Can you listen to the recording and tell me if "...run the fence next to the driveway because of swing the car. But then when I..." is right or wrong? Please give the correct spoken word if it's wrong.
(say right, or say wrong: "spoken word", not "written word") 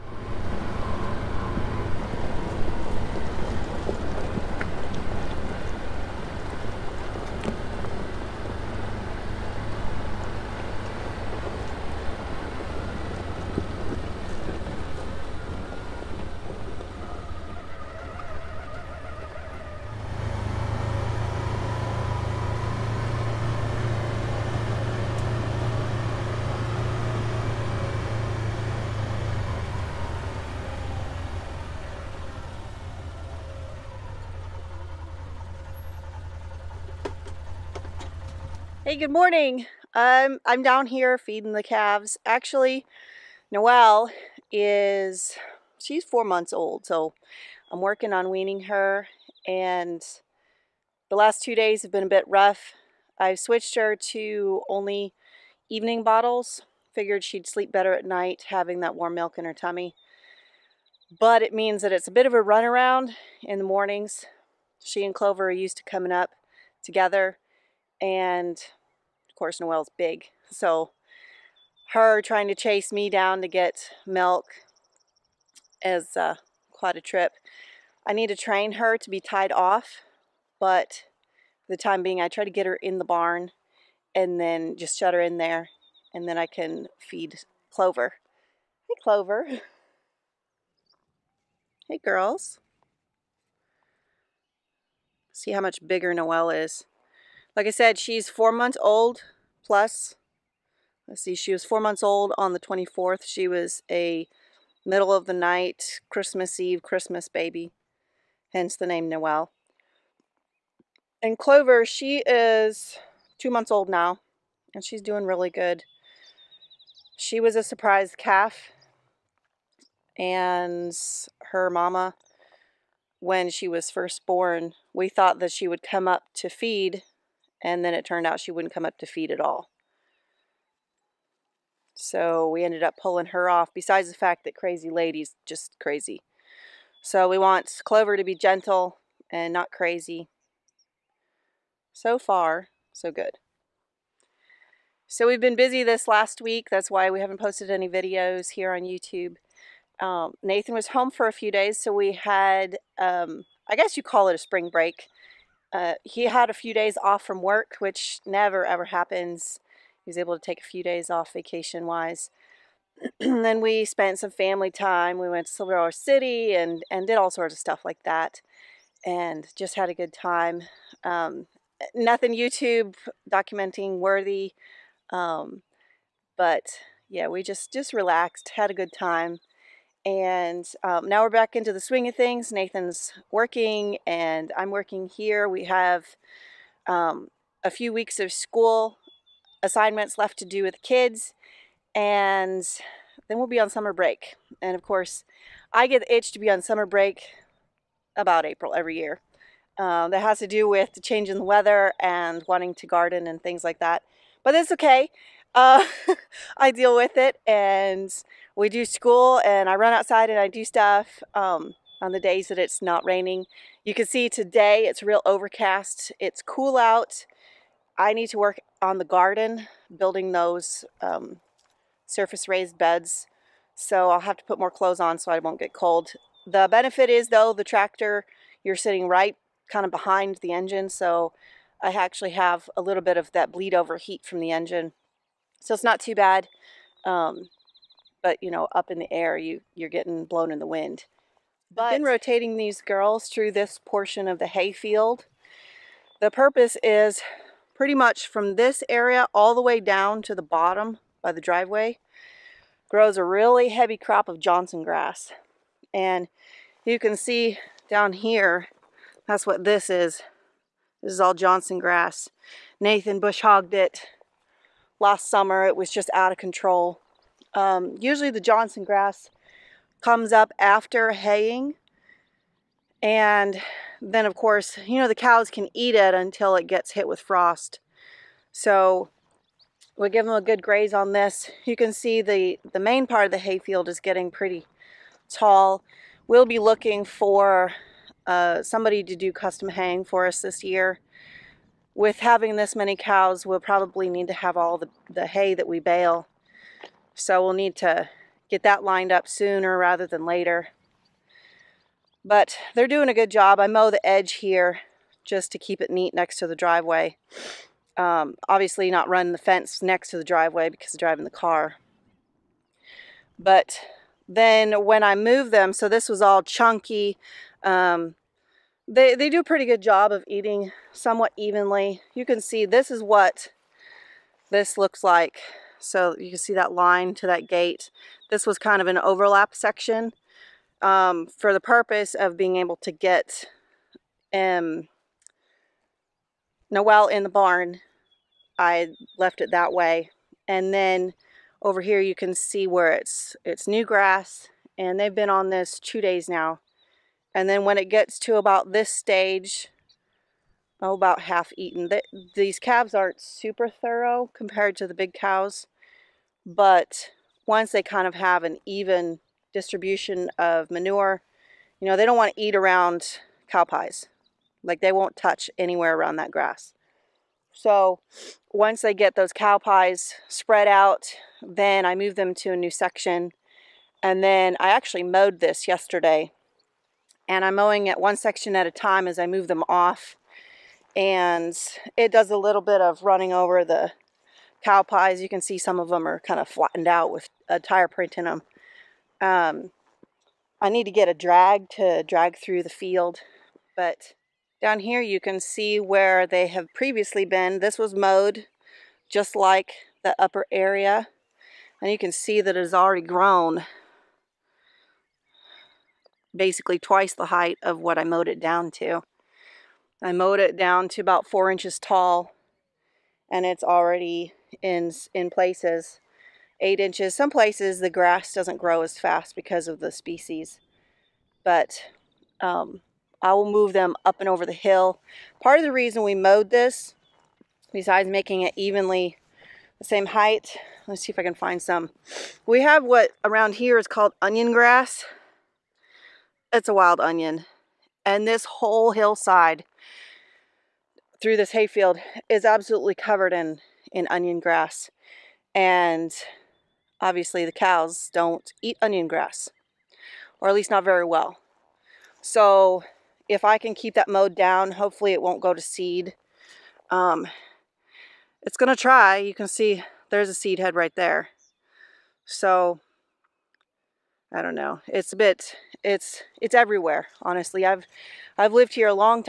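wrong: "driving", not "swing".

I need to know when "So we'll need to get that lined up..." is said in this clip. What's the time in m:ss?
4:57.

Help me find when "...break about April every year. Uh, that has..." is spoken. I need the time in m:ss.
3:16.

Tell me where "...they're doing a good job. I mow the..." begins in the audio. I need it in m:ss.
5:02.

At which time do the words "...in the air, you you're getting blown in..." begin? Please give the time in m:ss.
3:58.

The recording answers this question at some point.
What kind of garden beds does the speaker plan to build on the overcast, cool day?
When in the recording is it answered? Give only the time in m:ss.
3:42.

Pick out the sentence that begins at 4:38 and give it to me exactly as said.
So we give them a good graze on this.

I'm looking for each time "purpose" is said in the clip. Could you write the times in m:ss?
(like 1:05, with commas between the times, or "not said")
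4:06, 5:31.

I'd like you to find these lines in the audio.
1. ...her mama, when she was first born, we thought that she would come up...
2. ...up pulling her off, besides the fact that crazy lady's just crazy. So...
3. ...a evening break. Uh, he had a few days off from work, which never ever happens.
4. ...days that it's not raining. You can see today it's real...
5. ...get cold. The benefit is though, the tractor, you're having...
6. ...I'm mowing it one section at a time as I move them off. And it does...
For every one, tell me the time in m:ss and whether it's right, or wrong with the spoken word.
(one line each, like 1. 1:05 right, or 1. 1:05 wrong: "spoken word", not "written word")
1. 2:01 right
2. 2:12 right
3. 2:34 wrong: "spring", not "evening"
4. 3:32 right
5. 3:45 wrong: "sitting", not "having"
6. 6:17 right.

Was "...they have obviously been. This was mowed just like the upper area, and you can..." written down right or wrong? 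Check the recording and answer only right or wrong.
wrong.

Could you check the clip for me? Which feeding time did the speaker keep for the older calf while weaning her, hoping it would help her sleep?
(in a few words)
Evening bottles.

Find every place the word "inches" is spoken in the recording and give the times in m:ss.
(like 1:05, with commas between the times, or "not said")
6:51, 6:56.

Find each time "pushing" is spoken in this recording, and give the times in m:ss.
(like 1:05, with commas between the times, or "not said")
not said.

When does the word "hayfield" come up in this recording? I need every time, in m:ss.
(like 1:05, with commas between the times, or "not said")
4:04, 4:43, 7:21.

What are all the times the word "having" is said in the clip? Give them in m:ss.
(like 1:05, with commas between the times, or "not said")
0:58, 4:52.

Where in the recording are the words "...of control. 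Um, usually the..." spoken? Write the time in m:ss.
4:26.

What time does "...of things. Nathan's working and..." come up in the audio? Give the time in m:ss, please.
3:02.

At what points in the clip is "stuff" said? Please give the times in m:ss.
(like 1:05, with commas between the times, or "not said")
2:47, 3:30.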